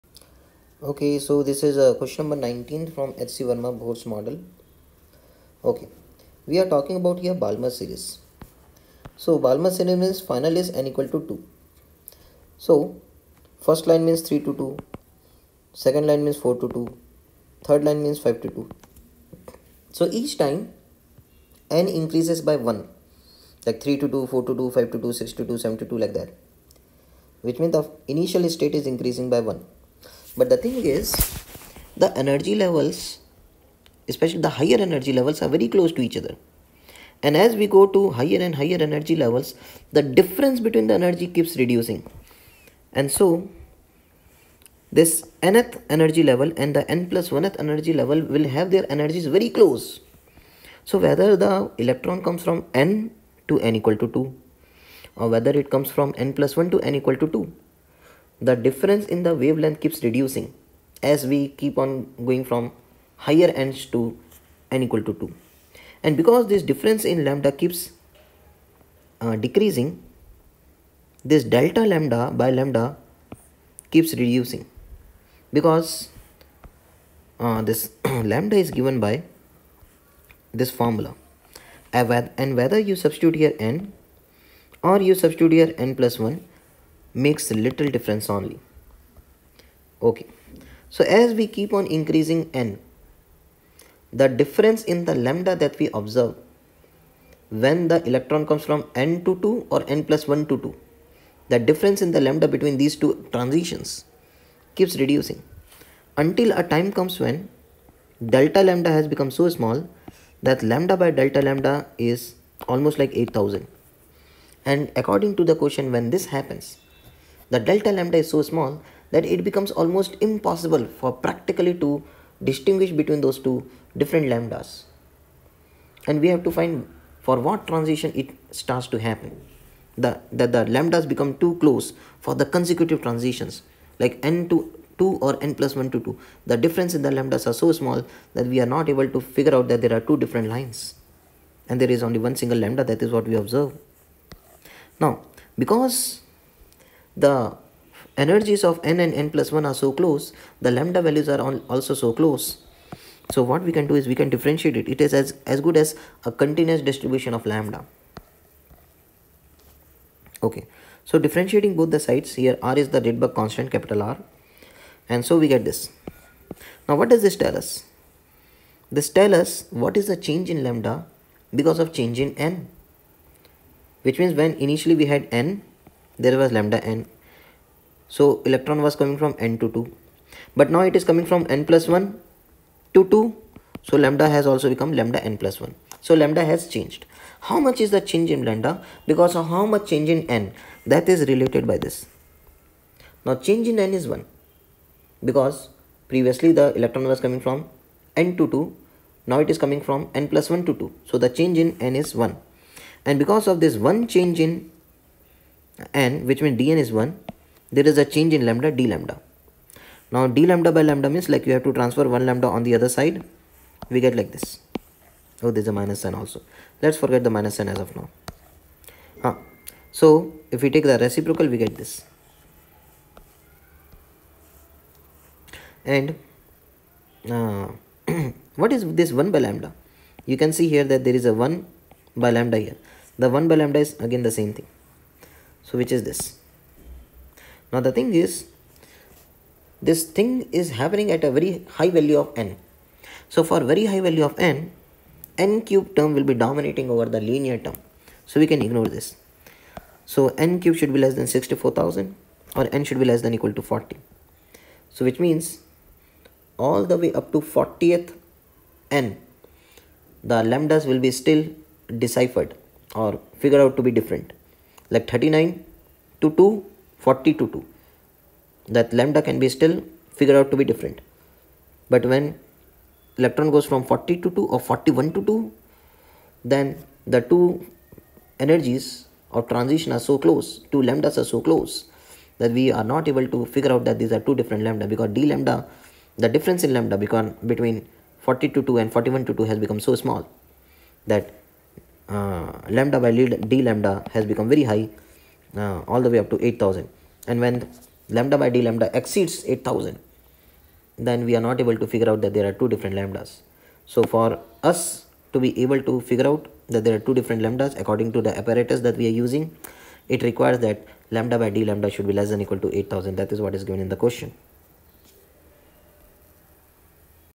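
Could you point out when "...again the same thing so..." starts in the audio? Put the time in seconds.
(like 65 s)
234 s.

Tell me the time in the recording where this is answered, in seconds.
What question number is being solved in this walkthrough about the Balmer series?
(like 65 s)
2 s.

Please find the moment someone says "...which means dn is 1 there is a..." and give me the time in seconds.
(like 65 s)
206 s.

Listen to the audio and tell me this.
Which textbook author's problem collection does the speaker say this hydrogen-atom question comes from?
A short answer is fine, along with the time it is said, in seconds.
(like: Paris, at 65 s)
HC Verma, at 3 s.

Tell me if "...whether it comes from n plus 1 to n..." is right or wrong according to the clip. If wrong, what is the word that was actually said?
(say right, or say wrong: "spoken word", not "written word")
right.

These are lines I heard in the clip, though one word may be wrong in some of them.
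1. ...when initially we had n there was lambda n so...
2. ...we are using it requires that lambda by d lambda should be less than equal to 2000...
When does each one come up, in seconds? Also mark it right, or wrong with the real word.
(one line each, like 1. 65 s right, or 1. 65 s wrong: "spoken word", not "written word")
1. 174 s right
2. 308 s wrong: "8000", not "2000".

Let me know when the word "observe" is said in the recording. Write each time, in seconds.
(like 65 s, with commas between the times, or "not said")
95 s, 143 s.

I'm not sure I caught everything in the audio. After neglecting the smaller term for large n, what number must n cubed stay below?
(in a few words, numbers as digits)
64000.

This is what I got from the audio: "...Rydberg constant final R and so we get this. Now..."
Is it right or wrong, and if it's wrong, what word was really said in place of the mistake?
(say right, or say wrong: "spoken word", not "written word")
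wrong: "capital", not "final".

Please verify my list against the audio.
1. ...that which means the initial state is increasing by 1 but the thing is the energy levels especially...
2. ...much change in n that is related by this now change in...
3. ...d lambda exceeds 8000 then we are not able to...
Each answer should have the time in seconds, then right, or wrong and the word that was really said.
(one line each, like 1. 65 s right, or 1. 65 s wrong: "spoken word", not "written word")
1. 26 s right
2. 189 s right
3. 298 s right.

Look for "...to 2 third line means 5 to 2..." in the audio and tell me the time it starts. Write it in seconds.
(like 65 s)
16 s.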